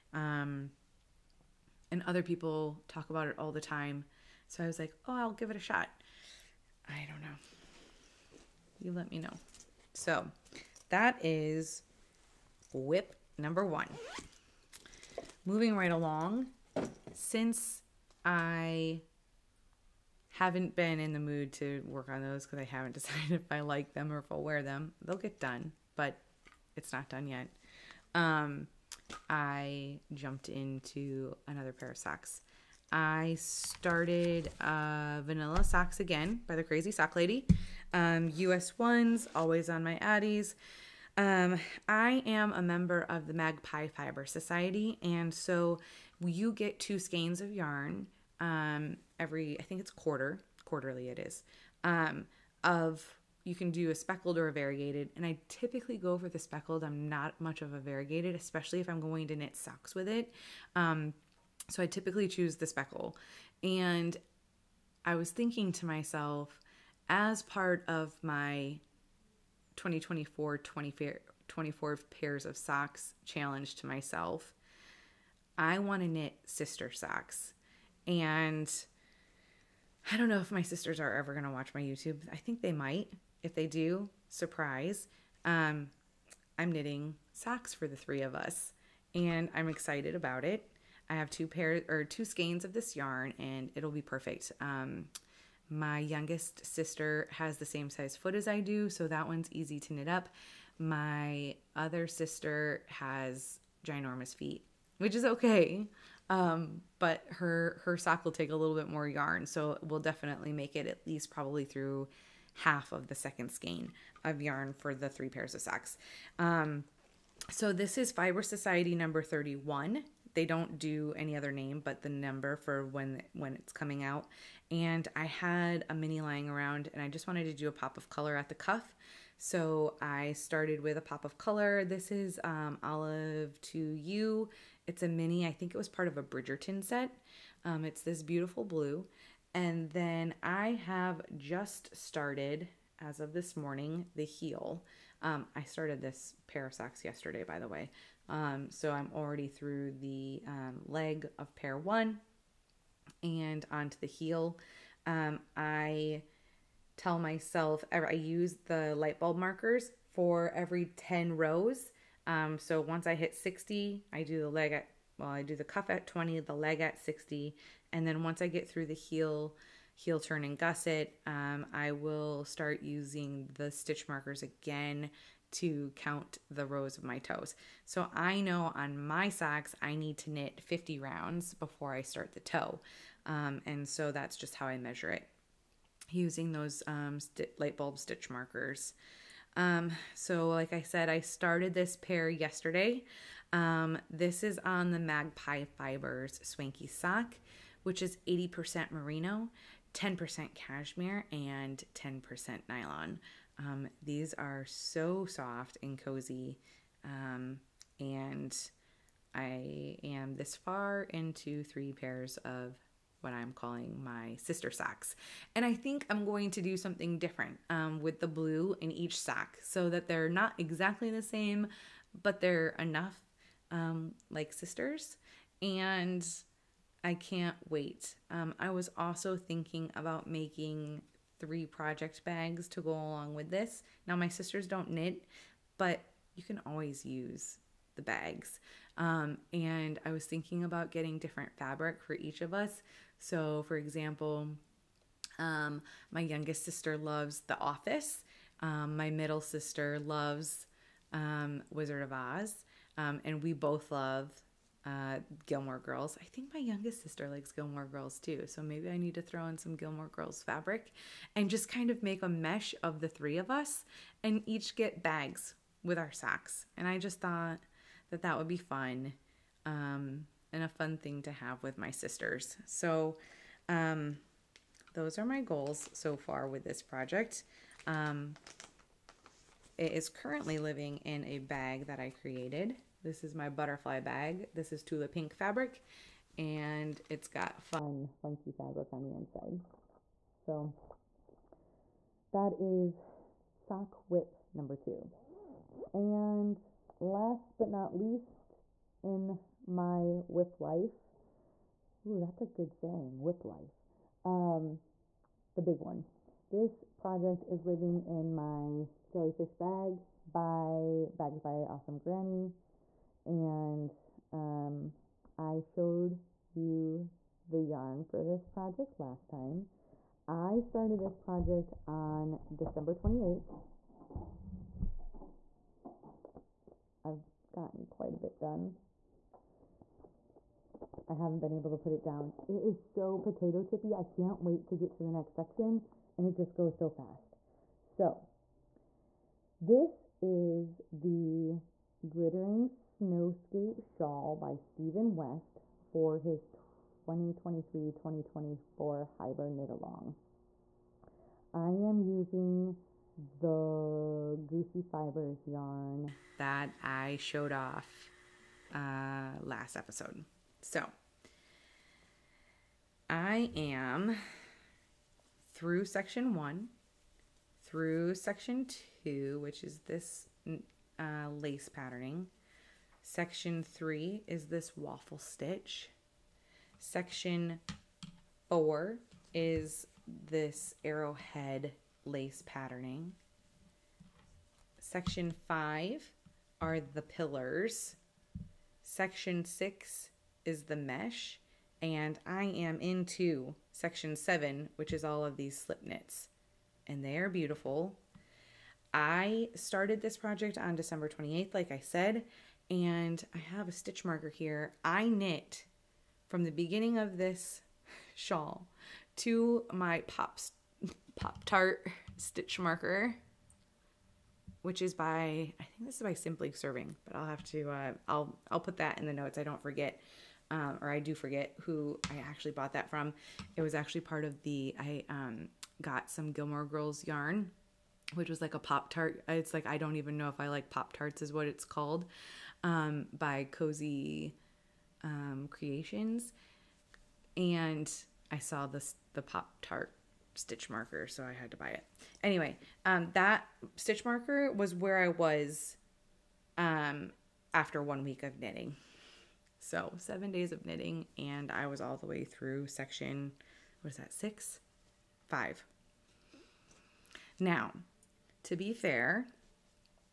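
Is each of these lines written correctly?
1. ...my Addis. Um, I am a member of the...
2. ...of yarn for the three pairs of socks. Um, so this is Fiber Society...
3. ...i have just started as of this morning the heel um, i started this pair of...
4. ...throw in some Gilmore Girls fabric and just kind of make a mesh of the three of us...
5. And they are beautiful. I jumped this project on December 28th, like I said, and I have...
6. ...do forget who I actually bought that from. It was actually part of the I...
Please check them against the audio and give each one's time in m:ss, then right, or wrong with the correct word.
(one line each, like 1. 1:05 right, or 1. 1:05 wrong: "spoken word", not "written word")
1. 0:39 right
2. 1:54 right
3. 2:20 right
4. 4:19 right
5. 6:36 wrong: "started", not "jumped"
6. 7:00 right.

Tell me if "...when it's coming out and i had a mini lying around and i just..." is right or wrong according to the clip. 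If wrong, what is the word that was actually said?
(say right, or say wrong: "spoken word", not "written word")
right.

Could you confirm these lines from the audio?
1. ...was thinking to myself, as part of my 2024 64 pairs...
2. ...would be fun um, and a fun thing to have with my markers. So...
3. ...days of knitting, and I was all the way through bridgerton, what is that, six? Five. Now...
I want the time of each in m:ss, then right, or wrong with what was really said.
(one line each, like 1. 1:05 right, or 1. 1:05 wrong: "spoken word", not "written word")
1. 1:05 wrong: "24", not "64"
2. 4:28 wrong: "sisters", not "markers"
3. 7:30 wrong: "section", not "bridgerton".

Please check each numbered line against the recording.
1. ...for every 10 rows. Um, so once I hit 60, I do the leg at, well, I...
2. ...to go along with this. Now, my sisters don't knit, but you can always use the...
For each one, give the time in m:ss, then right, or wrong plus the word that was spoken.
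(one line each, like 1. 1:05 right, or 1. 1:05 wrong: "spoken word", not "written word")
1. 2:40 right
2. 3:52 right.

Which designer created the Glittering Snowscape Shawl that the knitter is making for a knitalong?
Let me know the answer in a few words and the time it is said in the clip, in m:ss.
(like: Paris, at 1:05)
Stephen West, at 5:44.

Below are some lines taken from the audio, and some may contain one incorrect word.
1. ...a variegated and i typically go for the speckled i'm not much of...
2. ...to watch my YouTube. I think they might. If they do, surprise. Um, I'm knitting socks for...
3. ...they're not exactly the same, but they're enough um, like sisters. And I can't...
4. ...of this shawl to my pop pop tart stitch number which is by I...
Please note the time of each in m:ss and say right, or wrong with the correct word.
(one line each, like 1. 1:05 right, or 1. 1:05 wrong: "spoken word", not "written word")
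1. 0:54 right
2. 1:21 right
3. 3:40 right
4. 6:46 wrong: "marker", not "number".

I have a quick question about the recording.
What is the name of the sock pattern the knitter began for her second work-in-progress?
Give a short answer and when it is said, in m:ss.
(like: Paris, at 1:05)
Vanilla Socks Again, at 0:35.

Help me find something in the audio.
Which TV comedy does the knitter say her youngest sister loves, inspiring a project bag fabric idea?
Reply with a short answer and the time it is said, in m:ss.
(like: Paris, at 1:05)
The Office, at 4:07.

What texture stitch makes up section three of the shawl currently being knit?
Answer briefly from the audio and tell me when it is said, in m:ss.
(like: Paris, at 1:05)
Waffle stitch, at 6:14.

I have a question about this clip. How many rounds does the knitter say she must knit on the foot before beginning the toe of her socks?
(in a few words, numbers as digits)
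50.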